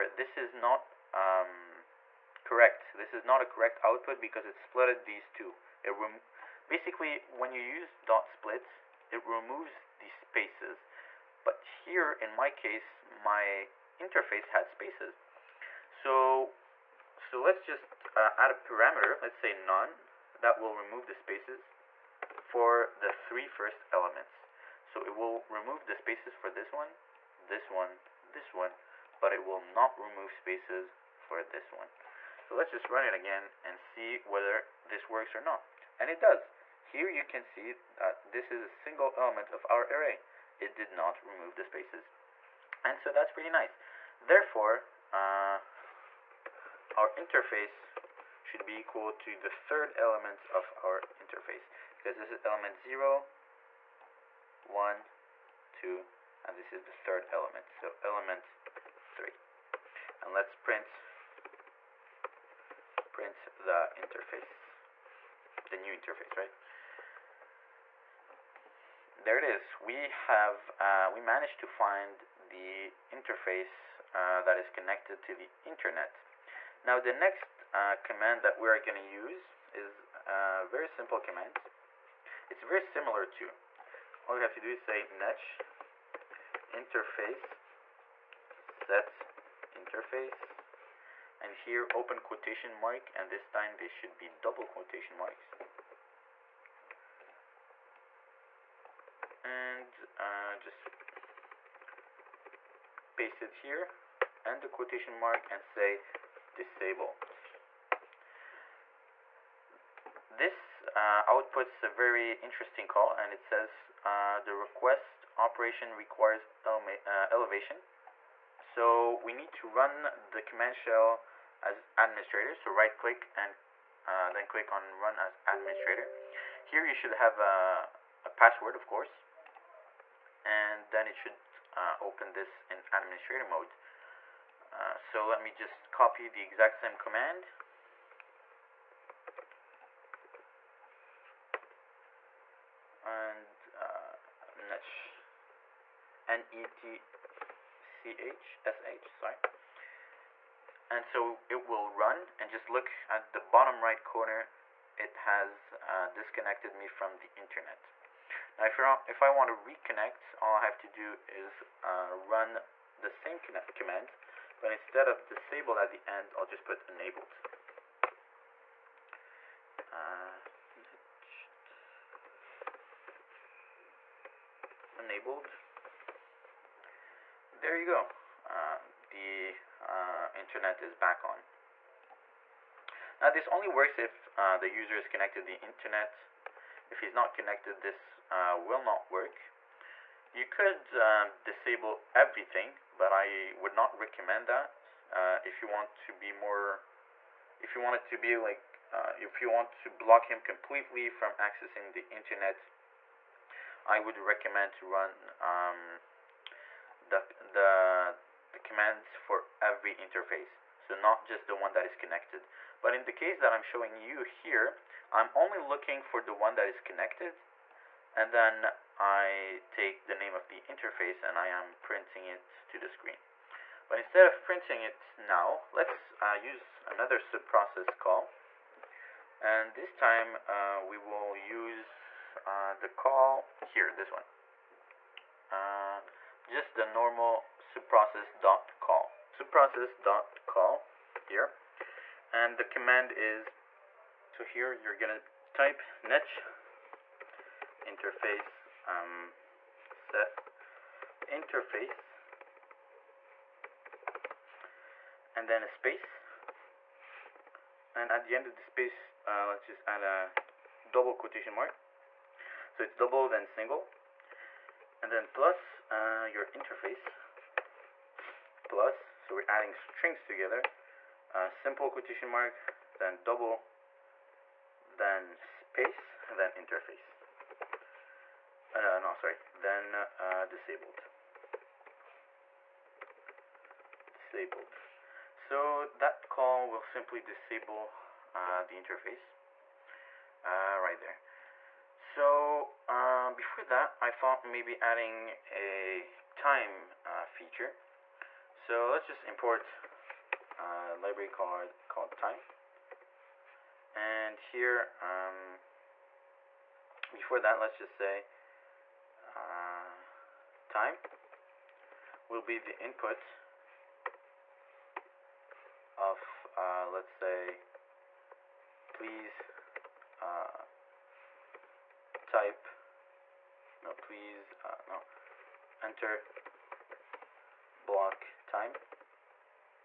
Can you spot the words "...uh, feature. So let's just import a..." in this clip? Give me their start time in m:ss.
4:57.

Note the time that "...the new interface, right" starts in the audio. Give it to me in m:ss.
1:05.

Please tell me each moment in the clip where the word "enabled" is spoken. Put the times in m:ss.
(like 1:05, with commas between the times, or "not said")
2:46, 2:54.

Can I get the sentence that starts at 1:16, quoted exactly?
Now the next uh, command that we are going to use is a uh, very simple command.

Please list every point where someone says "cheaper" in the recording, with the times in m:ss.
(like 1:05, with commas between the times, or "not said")
not said.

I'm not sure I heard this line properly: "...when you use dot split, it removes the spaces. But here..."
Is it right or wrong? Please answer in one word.
right.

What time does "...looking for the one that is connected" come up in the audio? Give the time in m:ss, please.
3:35.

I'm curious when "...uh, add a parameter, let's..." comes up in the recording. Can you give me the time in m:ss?
0:18.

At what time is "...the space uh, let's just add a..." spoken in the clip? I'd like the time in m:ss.
4:18.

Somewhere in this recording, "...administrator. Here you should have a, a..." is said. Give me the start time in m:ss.
2:05.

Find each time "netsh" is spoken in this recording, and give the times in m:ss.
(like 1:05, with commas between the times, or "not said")
1:25, 2:24, 4:06.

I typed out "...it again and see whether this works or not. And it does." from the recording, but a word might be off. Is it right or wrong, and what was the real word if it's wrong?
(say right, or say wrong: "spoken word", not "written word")
right.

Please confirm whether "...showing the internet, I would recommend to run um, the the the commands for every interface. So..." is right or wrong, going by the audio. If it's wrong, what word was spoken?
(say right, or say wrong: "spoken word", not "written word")
wrong: "accessing", not "showing".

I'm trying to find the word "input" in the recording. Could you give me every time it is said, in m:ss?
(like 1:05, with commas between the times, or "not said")
5:12.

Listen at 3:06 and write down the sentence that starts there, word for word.
If he's not connected, this uh, will not work.